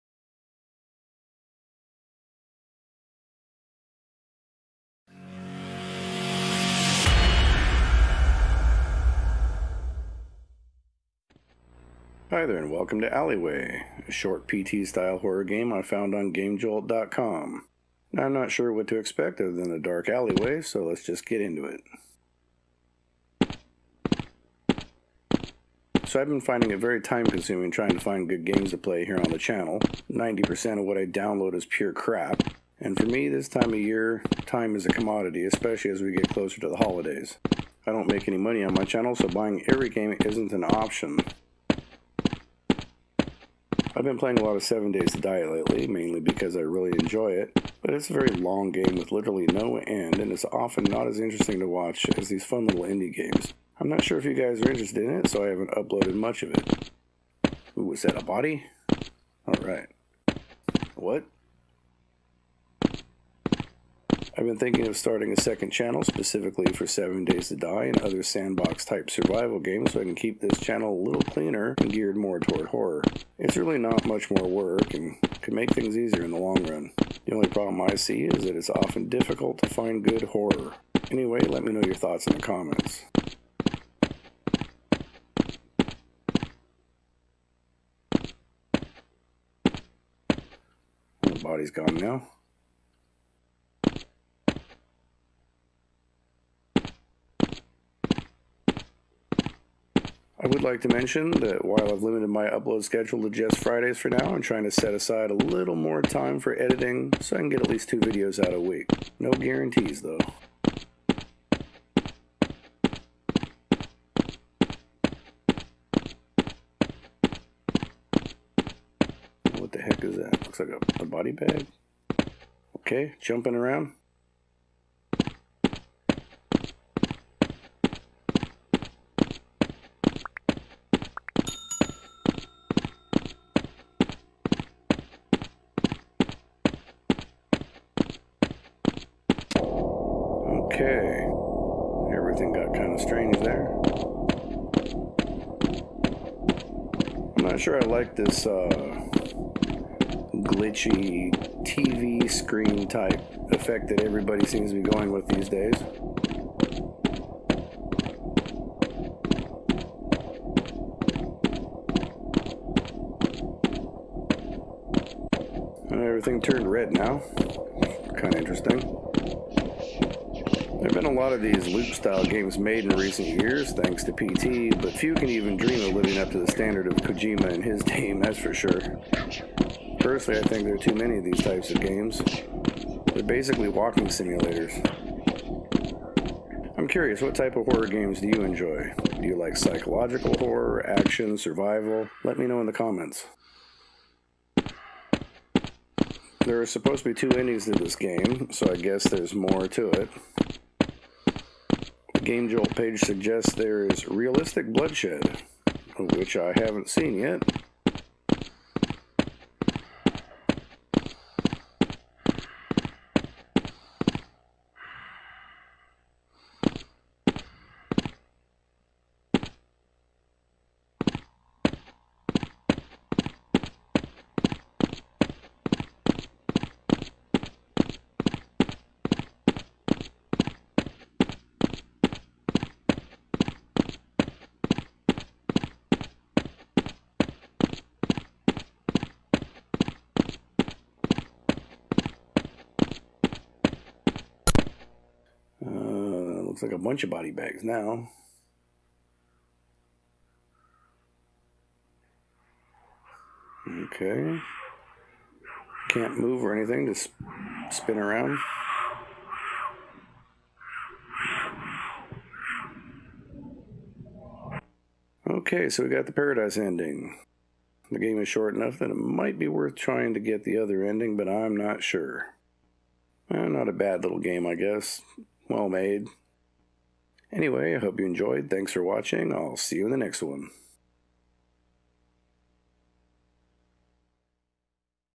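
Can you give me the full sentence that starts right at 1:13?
It's really not much more work and could make things easier in the long run.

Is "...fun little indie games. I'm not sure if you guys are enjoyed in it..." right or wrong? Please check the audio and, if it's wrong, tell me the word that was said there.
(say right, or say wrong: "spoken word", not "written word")
wrong: "interested", not "enjoyed".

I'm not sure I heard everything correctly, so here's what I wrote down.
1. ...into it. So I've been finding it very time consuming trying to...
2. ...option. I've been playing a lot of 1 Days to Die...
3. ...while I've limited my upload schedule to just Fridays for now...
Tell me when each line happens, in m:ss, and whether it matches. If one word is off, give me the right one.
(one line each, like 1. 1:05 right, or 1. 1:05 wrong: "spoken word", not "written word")
1. 0:21 right
2. 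0:40 wrong: "7", not "1"
3. 1:41 right.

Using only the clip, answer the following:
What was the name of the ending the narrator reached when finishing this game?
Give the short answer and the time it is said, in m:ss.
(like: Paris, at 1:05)
paradise ending, at 4:26.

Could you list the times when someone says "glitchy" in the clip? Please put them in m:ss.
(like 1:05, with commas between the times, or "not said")
2:30.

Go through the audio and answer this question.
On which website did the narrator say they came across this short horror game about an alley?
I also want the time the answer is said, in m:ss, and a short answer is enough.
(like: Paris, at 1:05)
GameJolt.com, at 0:16.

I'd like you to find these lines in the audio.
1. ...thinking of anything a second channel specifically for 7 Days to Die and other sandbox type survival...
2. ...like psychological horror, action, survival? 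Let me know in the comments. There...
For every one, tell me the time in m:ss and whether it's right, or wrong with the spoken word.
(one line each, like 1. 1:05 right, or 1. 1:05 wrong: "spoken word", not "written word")
1. 1:04 wrong: "starting", not "anything"
2. 3:09 right.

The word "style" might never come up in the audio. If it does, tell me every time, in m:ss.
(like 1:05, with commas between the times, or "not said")
0:14, 2:51.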